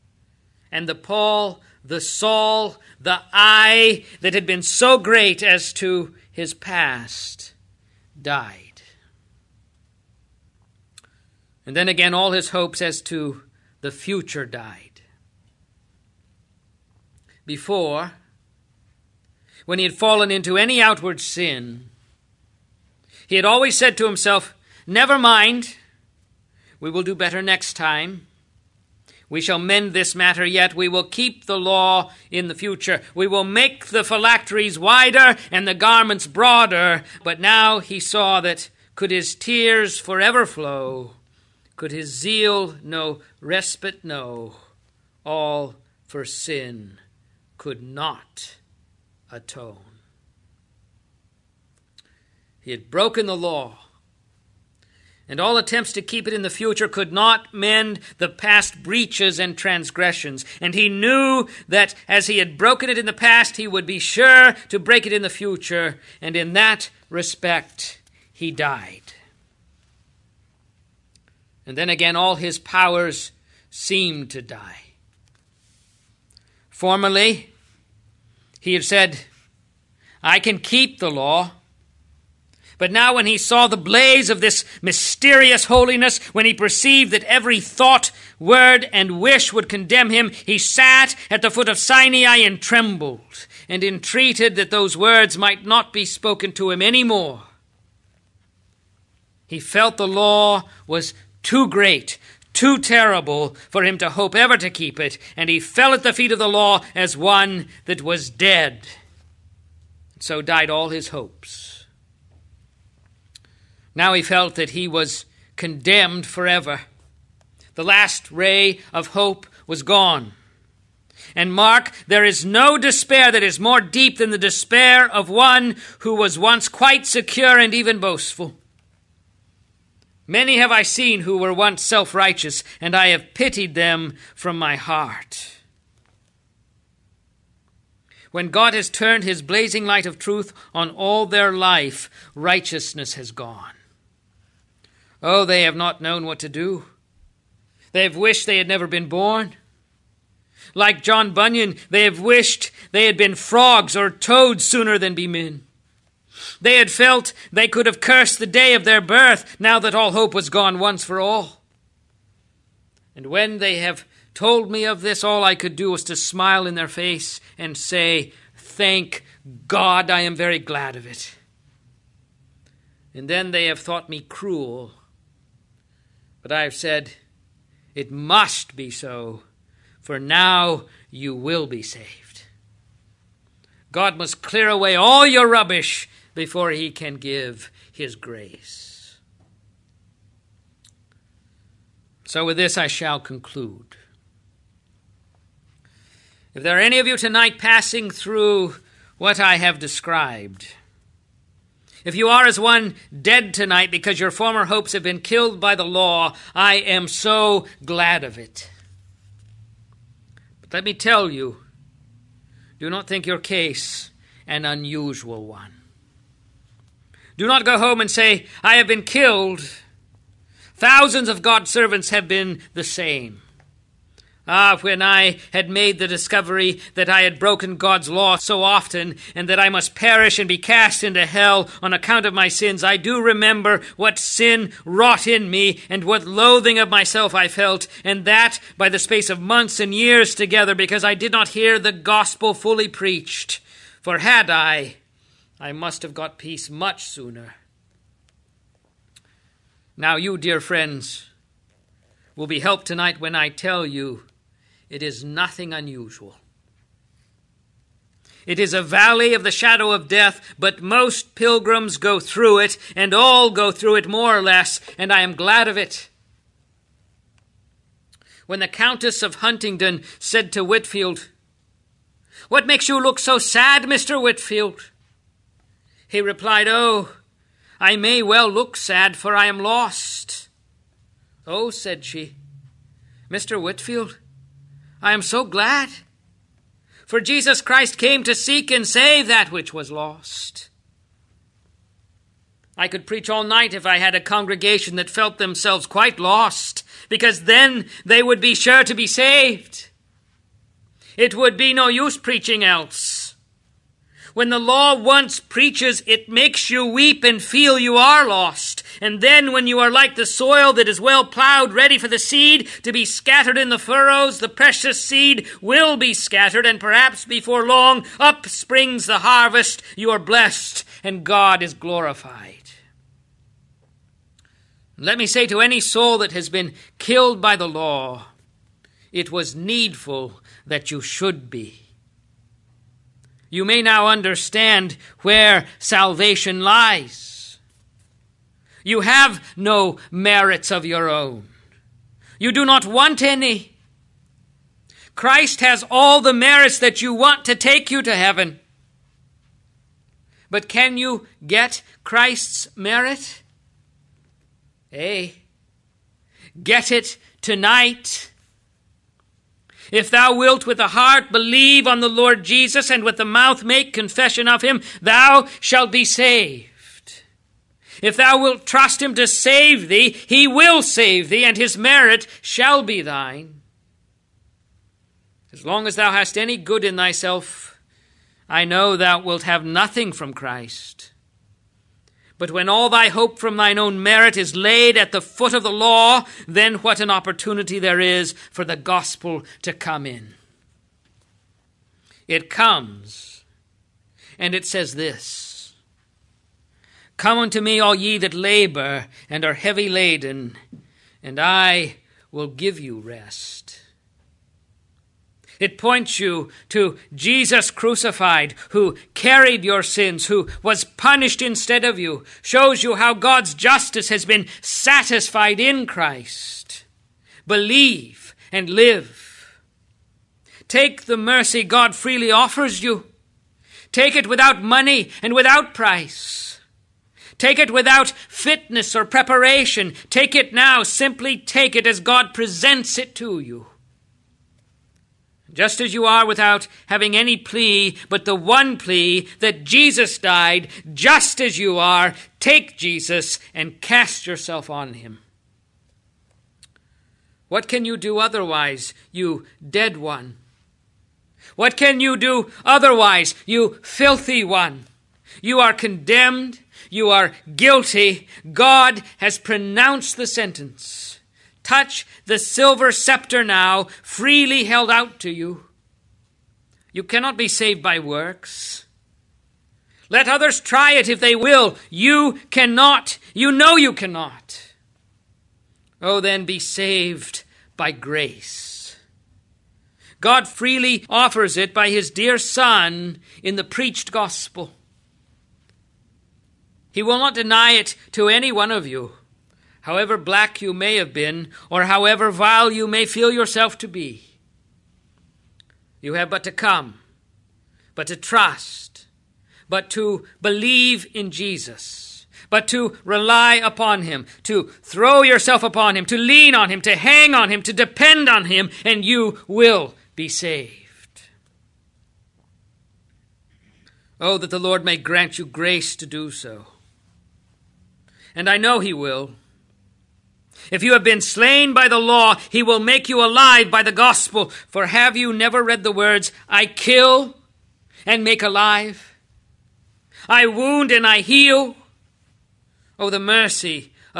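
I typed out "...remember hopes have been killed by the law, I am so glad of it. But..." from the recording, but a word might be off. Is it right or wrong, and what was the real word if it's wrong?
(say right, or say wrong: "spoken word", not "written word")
wrong: "former", not "remember".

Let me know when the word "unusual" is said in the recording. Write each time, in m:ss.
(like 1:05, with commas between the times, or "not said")
3:34, 4:15.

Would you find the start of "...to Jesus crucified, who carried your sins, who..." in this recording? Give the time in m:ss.
6:46.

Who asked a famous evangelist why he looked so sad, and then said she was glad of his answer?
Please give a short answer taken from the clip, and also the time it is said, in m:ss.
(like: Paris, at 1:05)
Countess of Huntingdon, at 4:28.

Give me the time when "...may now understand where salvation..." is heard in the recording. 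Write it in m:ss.
5:33.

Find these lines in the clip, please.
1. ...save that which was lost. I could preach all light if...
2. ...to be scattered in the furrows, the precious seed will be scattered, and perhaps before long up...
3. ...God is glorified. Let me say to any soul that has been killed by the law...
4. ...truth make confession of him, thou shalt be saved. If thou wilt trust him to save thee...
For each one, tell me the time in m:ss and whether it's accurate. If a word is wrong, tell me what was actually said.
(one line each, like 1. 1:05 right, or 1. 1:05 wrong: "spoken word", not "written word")
1. 4:48 wrong: "night", not "light"
2. 5:12 right
3. 5:21 right
4. 6:03 wrong: "mouth", not "truth".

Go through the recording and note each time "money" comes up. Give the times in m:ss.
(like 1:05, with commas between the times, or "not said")
7:04.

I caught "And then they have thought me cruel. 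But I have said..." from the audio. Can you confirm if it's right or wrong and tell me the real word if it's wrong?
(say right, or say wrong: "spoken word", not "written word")
right.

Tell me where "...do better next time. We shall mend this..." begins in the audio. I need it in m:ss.
0:27.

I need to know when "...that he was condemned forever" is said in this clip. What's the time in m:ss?
1:54.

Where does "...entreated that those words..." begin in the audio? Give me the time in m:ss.
1:33.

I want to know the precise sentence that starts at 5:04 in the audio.
When the law once preaches, it makes you weep and feel you are lost.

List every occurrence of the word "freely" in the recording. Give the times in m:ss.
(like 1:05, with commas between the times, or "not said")
7:01, 7:44, 8:00.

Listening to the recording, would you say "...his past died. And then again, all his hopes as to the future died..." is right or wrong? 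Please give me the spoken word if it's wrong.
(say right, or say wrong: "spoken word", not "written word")
right.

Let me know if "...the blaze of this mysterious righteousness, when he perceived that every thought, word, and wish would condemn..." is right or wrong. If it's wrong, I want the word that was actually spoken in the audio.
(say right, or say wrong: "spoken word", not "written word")
wrong: "holiness", not "righteousness".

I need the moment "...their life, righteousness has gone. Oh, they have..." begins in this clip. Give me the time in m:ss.
2:21.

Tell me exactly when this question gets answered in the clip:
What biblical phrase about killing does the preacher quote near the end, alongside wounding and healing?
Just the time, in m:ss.
8:46.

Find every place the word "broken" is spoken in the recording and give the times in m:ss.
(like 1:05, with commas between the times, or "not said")
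0:52, 1:02, 3:47.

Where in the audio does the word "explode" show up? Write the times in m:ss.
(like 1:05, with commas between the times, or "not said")
not said.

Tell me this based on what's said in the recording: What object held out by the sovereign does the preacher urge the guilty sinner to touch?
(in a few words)
silver scepter.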